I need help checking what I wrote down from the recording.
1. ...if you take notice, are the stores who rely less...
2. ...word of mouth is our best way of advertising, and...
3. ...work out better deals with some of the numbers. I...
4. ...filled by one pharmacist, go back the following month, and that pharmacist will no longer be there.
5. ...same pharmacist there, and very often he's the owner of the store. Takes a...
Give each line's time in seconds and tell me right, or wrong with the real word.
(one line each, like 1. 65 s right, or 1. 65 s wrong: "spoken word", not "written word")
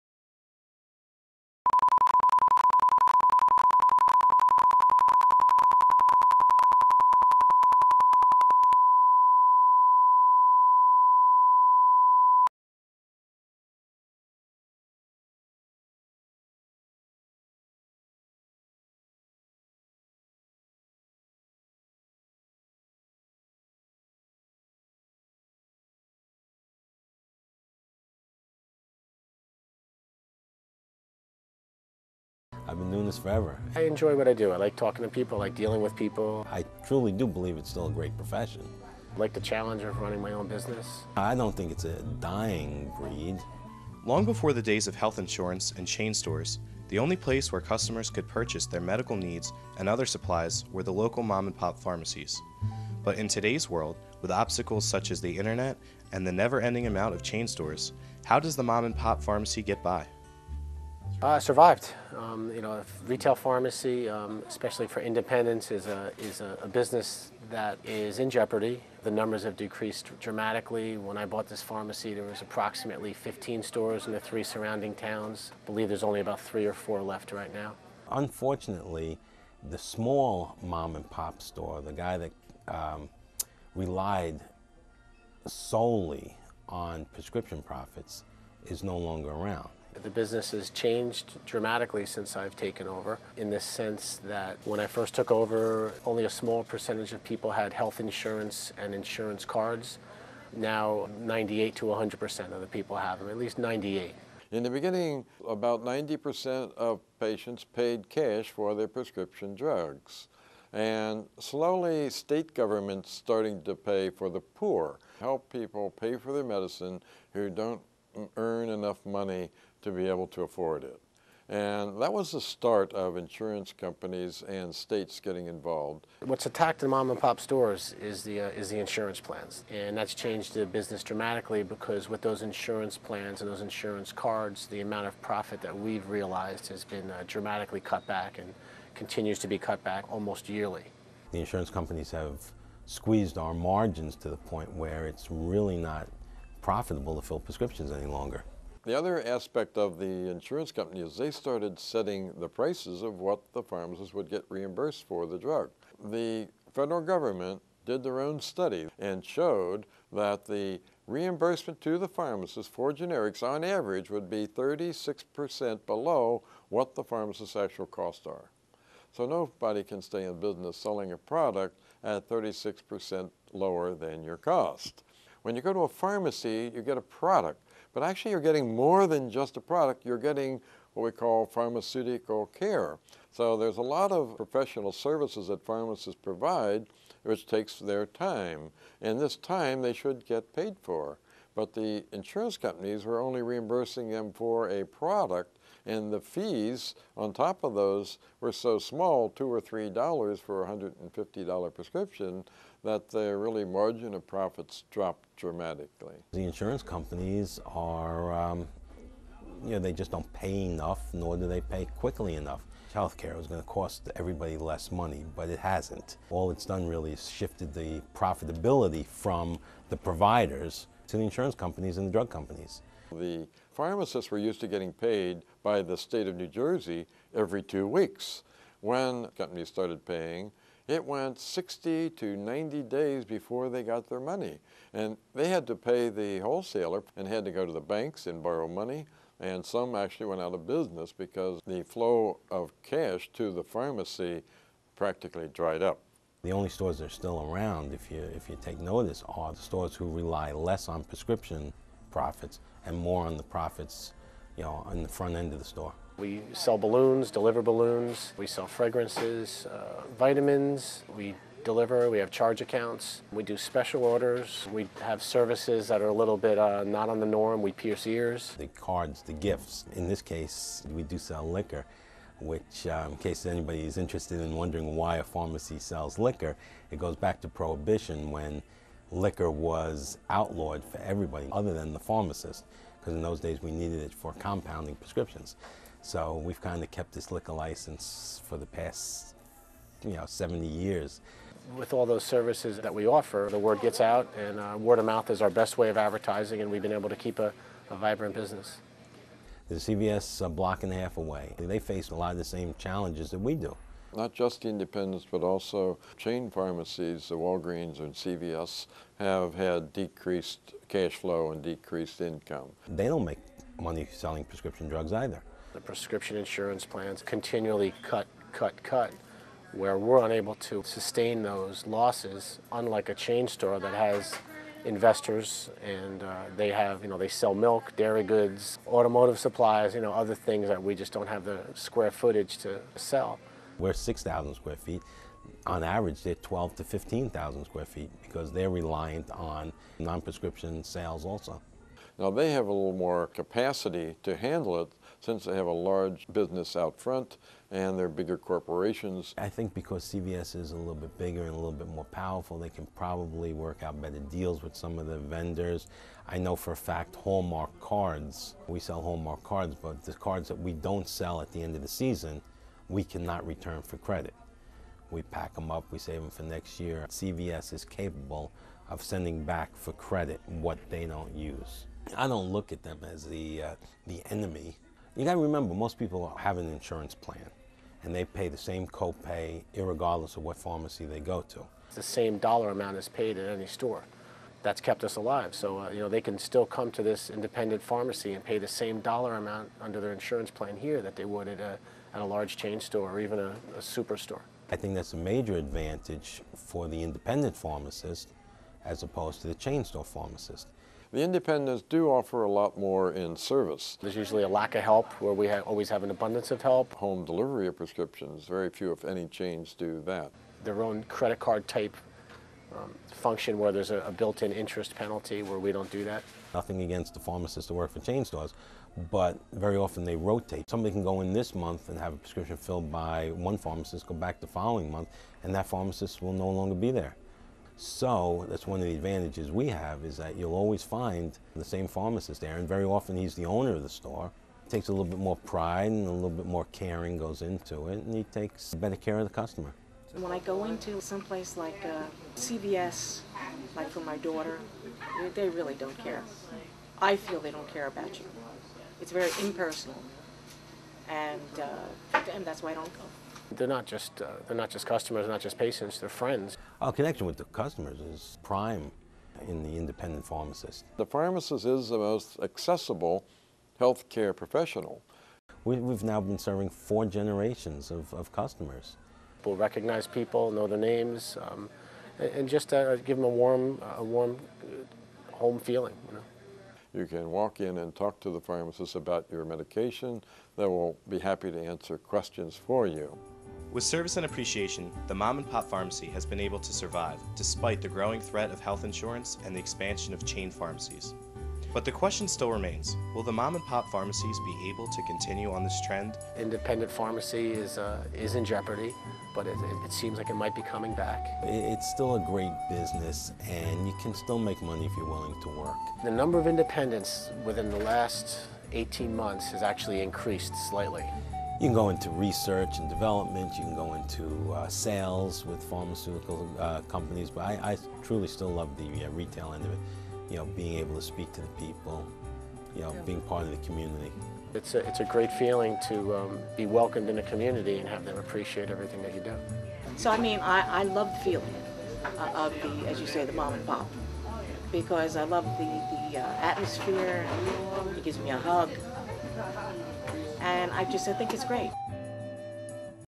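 1. 248 s right
2. 294 s right
3. 353 s wrong: "vendors", not "numbers"
4. 422 s right
5. 431 s right.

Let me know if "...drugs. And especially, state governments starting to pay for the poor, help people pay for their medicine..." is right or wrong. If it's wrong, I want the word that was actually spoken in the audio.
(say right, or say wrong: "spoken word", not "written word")
wrong: "slowly", not "especially".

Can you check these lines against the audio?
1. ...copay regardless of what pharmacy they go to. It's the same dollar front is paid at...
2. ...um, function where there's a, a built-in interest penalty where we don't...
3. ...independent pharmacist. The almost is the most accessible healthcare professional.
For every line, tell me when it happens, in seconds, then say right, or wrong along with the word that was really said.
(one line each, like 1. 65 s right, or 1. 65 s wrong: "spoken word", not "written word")
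1. 378 s wrong: "amount", not "front"
2. 412 s right
3. 459 s wrong: "pharmacist", not "almost".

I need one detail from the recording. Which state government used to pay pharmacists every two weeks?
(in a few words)
New Jersey.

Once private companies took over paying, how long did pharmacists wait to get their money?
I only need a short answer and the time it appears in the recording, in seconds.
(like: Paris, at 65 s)
60 to 90 days, at 231 s.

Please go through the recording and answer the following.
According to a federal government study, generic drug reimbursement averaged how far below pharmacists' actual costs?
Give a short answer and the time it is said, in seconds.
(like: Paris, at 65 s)
36%, at 164 s.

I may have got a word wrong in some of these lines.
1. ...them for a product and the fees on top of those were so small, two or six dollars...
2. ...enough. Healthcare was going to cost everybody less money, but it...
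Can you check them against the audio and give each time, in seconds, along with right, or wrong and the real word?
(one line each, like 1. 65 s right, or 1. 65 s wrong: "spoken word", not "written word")
1. 194 s wrong: "three", not "six"
2. 212 s right.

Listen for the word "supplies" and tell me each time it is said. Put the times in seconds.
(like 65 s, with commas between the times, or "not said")
50 s, 329 s.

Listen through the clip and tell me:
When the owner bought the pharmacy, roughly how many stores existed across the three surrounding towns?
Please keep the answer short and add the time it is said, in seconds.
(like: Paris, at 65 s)
15, at 72 s.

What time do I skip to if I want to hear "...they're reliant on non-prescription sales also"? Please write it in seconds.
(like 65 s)
338 s.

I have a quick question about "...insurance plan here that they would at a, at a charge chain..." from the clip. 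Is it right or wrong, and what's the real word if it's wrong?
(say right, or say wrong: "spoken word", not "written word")
wrong: "large", not "charge".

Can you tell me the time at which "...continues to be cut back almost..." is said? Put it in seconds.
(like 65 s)
138 s.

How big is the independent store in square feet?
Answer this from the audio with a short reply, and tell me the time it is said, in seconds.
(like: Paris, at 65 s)
6,000 square feet, at 333 s.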